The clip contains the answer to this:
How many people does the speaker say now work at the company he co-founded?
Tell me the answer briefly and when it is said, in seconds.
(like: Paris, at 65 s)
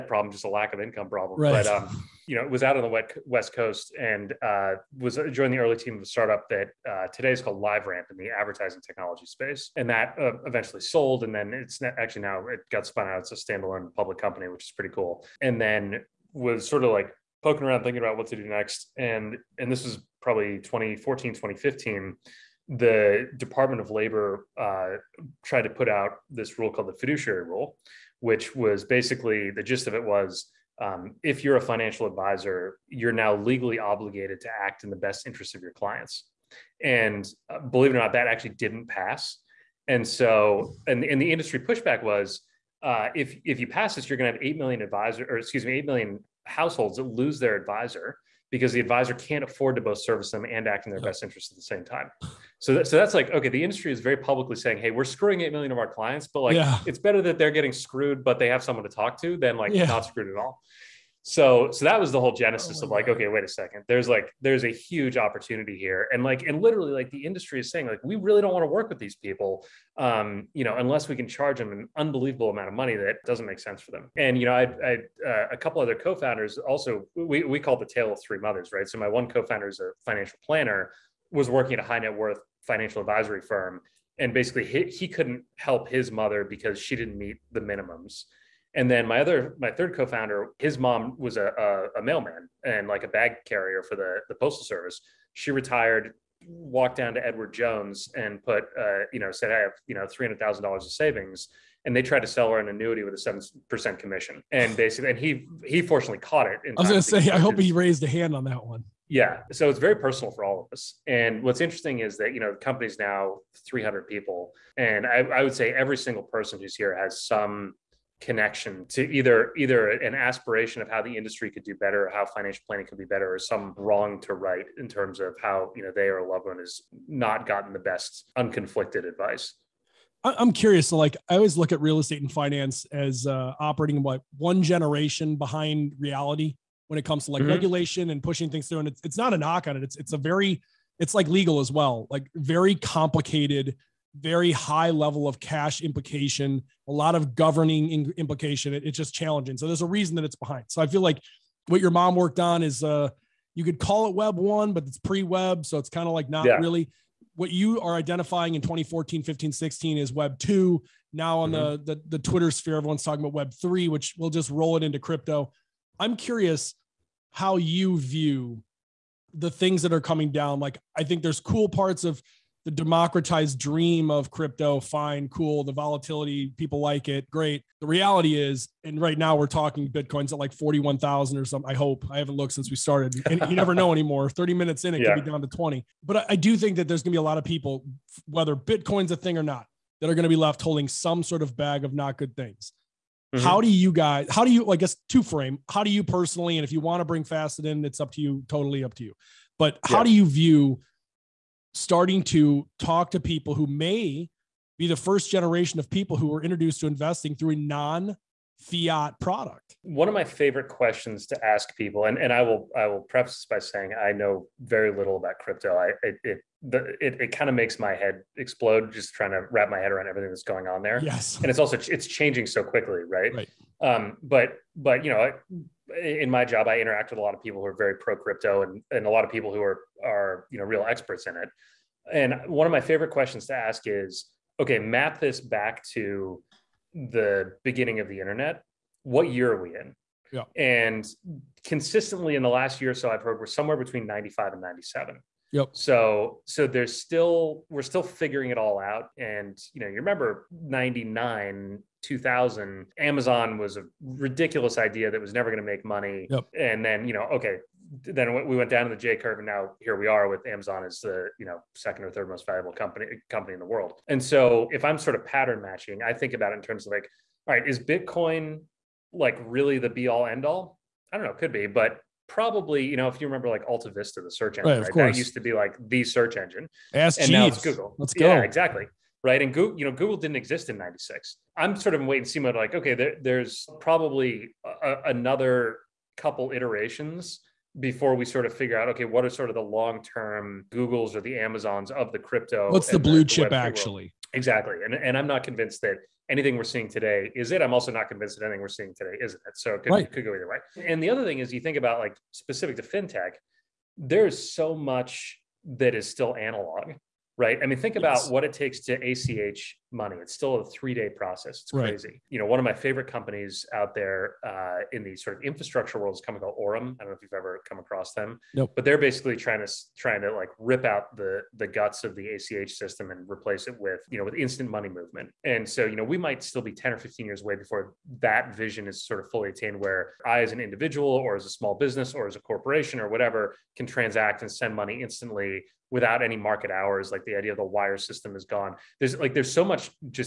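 300, at 113 s.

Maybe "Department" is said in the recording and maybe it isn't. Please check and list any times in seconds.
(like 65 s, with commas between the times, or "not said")
23 s.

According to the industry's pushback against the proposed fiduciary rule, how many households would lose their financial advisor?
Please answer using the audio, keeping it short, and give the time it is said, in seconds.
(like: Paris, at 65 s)
8 million households, at 45 s.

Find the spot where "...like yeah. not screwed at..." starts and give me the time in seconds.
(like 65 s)
59 s.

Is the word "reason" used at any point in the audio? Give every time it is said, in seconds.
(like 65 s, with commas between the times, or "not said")
149 s.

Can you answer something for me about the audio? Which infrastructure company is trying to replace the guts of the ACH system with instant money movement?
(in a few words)
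Orum.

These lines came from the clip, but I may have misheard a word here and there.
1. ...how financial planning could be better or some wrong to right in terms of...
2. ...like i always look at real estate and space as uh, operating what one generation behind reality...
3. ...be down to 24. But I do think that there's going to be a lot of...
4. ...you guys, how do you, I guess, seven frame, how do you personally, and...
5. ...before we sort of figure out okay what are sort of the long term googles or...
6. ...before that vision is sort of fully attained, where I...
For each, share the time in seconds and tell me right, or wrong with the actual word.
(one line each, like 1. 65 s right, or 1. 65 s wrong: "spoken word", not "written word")
1. 122 s right
2. 130 s wrong: "finance", not "space"
3. 185 s wrong: "20", not "24"
4. 193 s wrong: "two", not "seven"
5. 287 s right
6. 327 s right.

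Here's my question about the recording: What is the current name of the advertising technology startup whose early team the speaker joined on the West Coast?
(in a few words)
LiveRamp.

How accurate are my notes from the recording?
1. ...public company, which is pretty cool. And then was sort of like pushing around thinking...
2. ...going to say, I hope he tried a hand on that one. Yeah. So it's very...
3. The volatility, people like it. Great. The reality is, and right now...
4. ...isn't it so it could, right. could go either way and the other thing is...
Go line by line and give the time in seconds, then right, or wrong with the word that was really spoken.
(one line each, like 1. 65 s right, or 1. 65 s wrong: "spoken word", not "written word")
1. 13 s wrong: "poking", not "pushing"
2. 106 s wrong: "raised", not "tried"
3. 175 s right
4. 299 s right.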